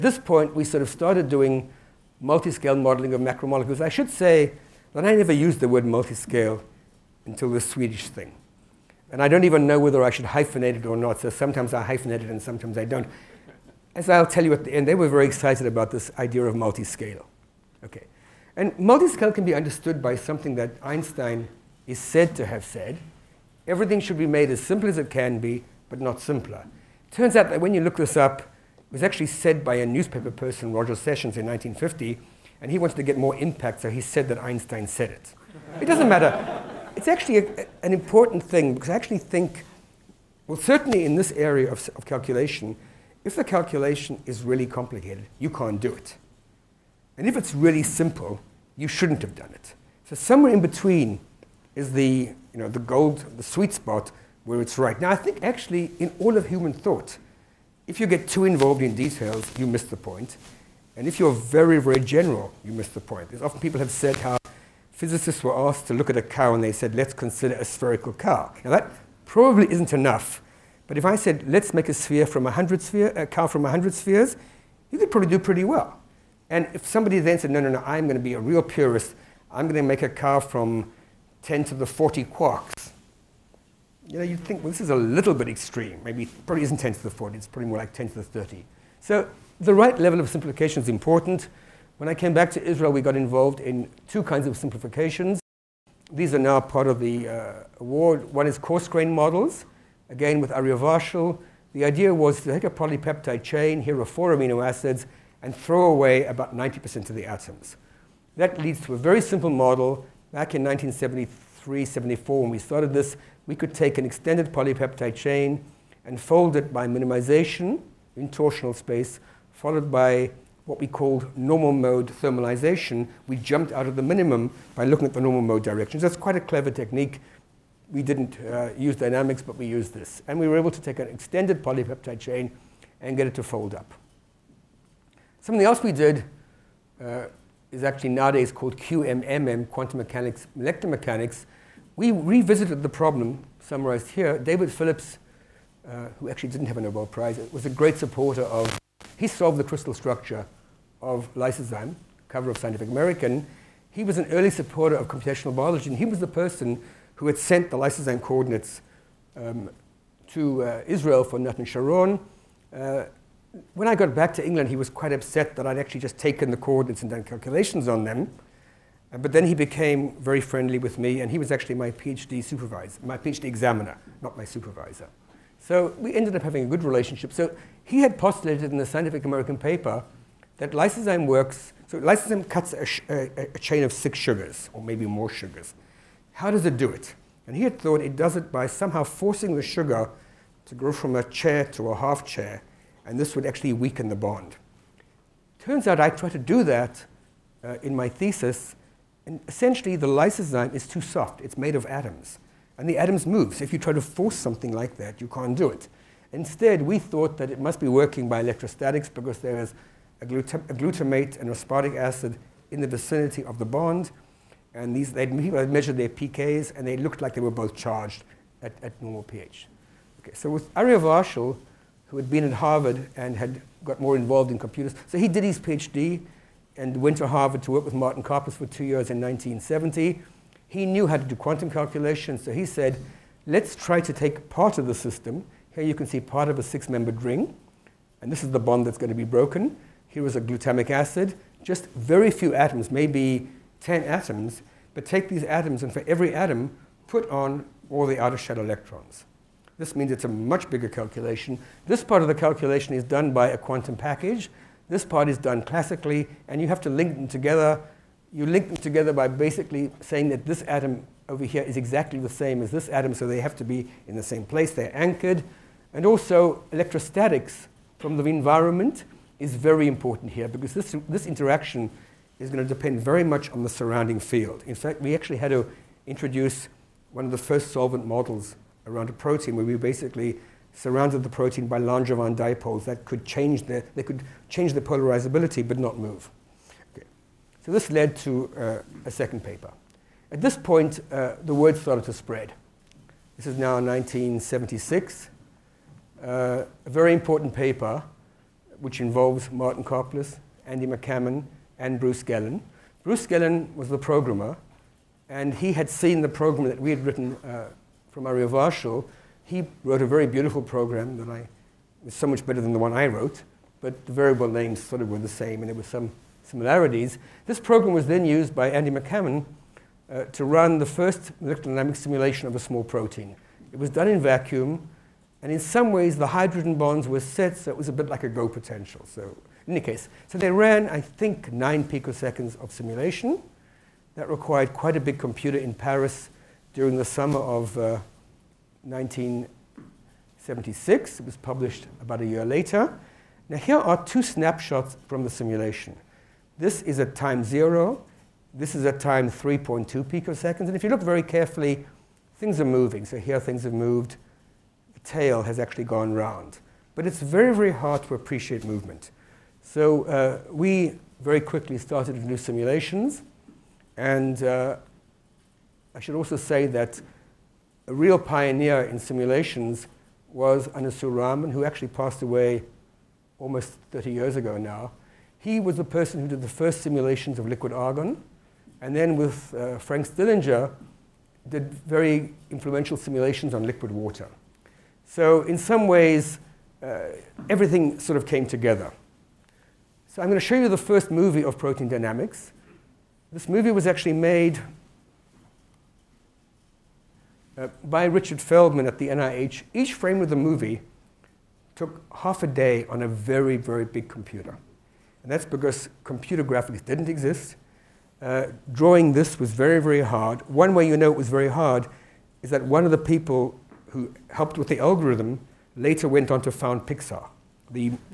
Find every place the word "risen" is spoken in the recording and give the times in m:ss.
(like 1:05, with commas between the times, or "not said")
not said.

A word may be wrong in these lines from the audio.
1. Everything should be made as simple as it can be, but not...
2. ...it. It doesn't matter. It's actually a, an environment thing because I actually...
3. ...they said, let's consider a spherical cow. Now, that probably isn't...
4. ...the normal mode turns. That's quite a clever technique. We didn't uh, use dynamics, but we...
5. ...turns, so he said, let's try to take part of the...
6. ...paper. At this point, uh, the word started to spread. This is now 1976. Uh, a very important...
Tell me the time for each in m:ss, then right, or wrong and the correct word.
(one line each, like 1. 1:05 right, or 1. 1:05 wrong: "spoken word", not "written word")
1. 0:23 right
2. 0:35 wrong: "important", not "environment"
3. 1:06 right
4. 2:05 wrong: "directions", not "turns"
5. 3:51 wrong: "calculations", not "turns"
6. 4:49 right.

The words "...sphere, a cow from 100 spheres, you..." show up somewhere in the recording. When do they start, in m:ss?
1:12.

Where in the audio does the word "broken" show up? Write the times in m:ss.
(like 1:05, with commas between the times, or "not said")
3:59.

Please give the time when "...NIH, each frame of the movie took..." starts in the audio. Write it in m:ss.
6:39.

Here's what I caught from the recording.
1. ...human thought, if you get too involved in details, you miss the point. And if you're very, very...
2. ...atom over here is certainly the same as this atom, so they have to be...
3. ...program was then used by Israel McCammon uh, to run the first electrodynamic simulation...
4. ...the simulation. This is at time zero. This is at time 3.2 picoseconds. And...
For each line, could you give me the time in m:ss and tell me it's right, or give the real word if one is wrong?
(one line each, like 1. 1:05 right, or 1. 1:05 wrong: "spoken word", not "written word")
1. 0:56 right
2. 4:20 wrong: "exactly", not "certainly"
3. 5:17 wrong: "Andy", not "Israel"
4. 5:45 right.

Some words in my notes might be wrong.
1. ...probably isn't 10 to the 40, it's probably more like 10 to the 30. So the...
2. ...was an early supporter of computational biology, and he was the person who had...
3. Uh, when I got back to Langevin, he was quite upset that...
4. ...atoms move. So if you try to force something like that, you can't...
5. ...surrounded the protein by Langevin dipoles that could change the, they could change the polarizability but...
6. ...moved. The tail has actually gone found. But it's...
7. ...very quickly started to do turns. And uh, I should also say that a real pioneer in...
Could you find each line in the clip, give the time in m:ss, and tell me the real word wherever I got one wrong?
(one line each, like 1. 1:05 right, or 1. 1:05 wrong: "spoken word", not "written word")
1. 1:26 right
2. 2:34 right
3. 2:42 wrong: "England", not "Langevin"
4. 3:22 right
5. 4:40 right
6. 5:53 wrong: "round", not "found"
7. 6:01 wrong: "simulations", not "turns".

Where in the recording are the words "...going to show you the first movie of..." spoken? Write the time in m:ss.
6:30.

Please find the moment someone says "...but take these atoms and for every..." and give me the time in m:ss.
4:04.